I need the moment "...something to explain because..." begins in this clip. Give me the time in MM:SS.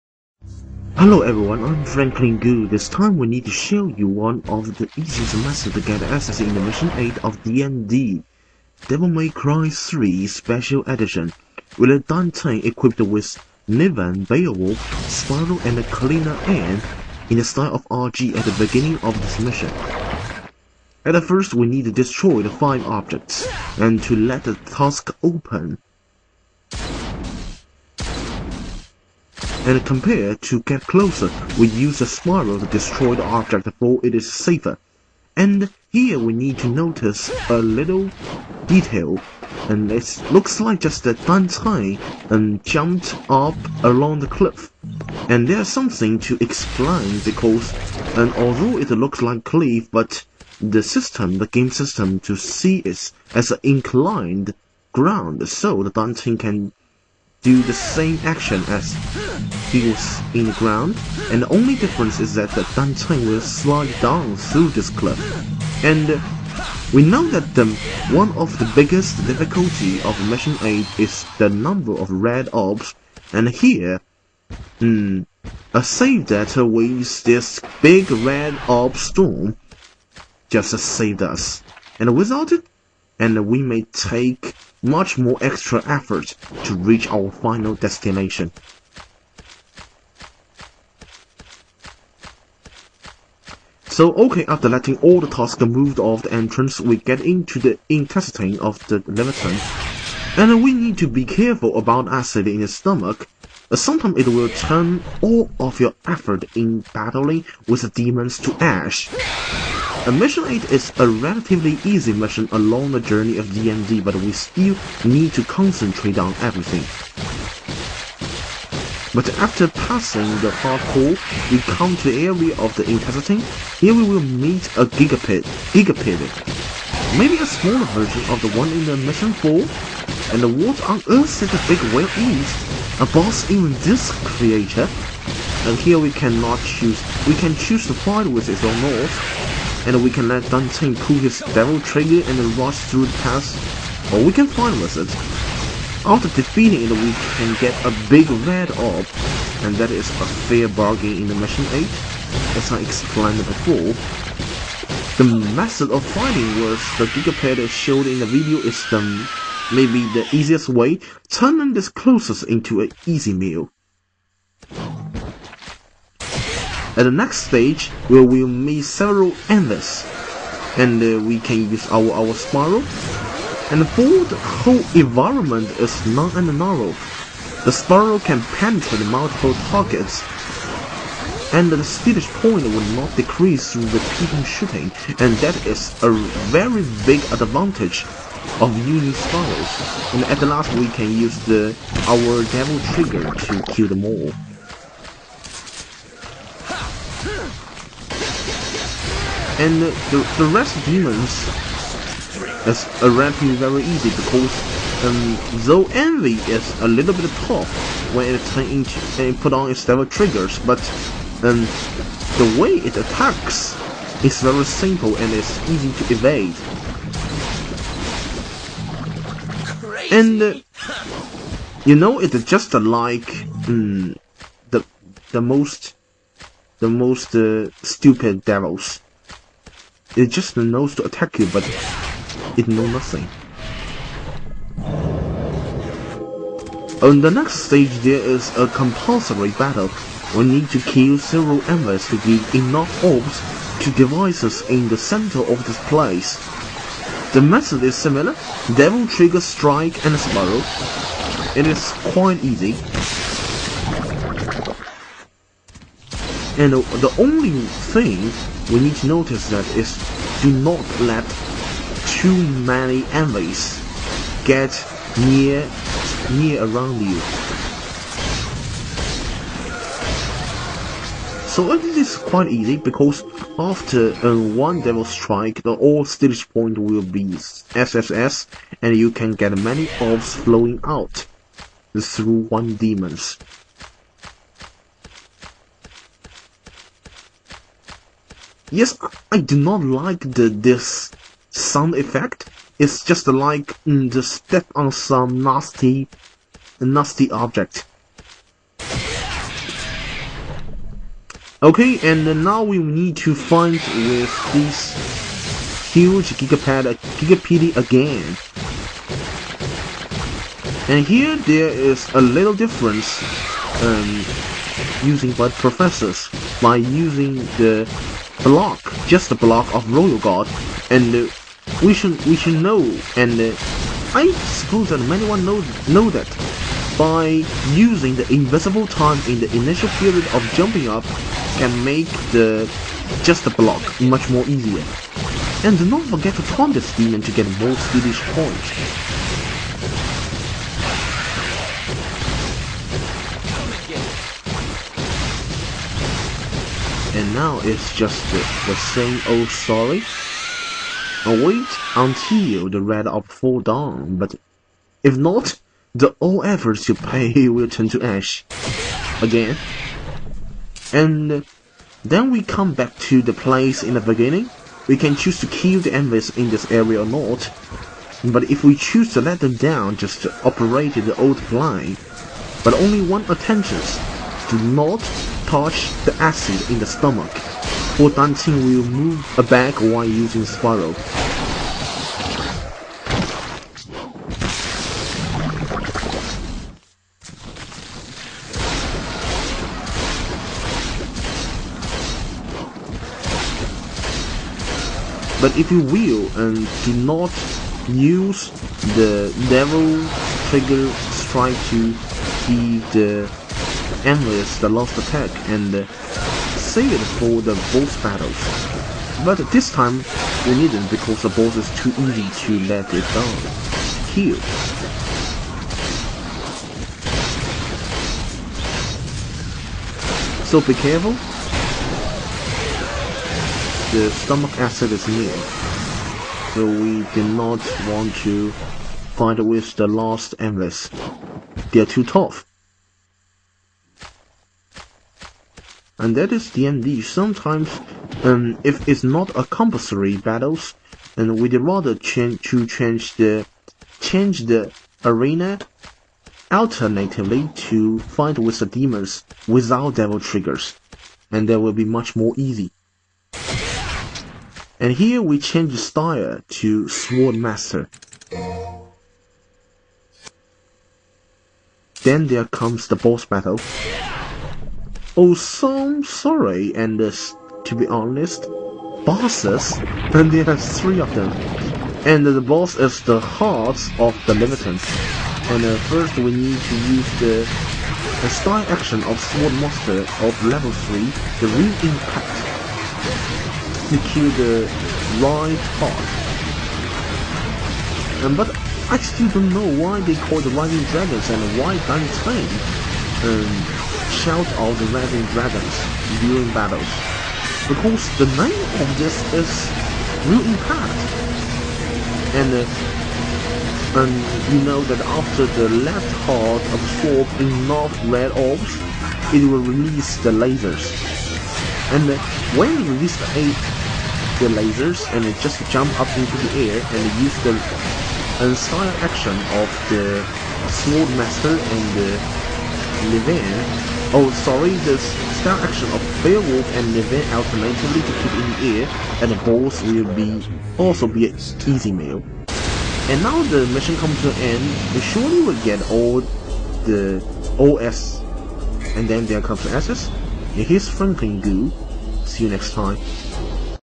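00:45.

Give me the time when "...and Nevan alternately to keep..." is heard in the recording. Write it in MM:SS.
08:46.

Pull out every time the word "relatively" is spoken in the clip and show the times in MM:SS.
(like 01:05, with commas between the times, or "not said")
01:51, 03:23.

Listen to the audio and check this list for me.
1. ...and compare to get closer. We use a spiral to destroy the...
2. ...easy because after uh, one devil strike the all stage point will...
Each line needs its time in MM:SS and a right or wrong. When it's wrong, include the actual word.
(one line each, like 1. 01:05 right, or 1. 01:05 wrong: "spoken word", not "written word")
1. 00:29 right
2. 04:32 right.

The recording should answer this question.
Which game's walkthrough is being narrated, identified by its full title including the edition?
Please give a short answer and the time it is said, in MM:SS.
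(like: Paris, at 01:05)
Devil May Cry 3 Special Edition, at 00:08.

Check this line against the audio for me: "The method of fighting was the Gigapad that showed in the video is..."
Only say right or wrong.
right.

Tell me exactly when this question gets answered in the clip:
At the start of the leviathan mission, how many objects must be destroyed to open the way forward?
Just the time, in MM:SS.
00:22.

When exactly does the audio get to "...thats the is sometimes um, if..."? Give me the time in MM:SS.
07:16.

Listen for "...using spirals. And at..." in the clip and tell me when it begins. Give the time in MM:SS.
03:08.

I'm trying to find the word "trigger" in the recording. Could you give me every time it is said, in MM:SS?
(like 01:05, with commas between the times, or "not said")
02:21, 03:12, 03:30, 04:09, 06:40, 07:30.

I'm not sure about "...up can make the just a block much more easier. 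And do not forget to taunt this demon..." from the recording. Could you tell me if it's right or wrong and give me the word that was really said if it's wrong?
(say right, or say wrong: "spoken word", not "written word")
right.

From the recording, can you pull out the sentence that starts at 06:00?
And then we come back to the place in the beginning.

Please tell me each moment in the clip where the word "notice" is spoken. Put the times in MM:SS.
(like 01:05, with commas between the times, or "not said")
00:36, 04:19.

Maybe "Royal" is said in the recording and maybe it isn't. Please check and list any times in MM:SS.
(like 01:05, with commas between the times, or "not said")
05:19.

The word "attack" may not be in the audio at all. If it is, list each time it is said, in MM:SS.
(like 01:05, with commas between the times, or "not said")
03:32, 03:51, 06:44.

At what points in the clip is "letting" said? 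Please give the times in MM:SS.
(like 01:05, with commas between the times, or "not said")
01:34.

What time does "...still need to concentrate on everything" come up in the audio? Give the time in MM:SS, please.
01:54.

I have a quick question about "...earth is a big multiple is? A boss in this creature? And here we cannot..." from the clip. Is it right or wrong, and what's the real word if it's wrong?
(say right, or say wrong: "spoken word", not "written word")
wrong: "whale", not "multiple".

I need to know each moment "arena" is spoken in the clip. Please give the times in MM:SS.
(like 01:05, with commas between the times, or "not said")
07:25.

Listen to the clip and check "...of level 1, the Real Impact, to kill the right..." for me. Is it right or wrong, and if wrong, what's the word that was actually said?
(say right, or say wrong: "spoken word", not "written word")
wrong: "3", not "1".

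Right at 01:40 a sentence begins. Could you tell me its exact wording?
And we need to be careful about acid in the stomach.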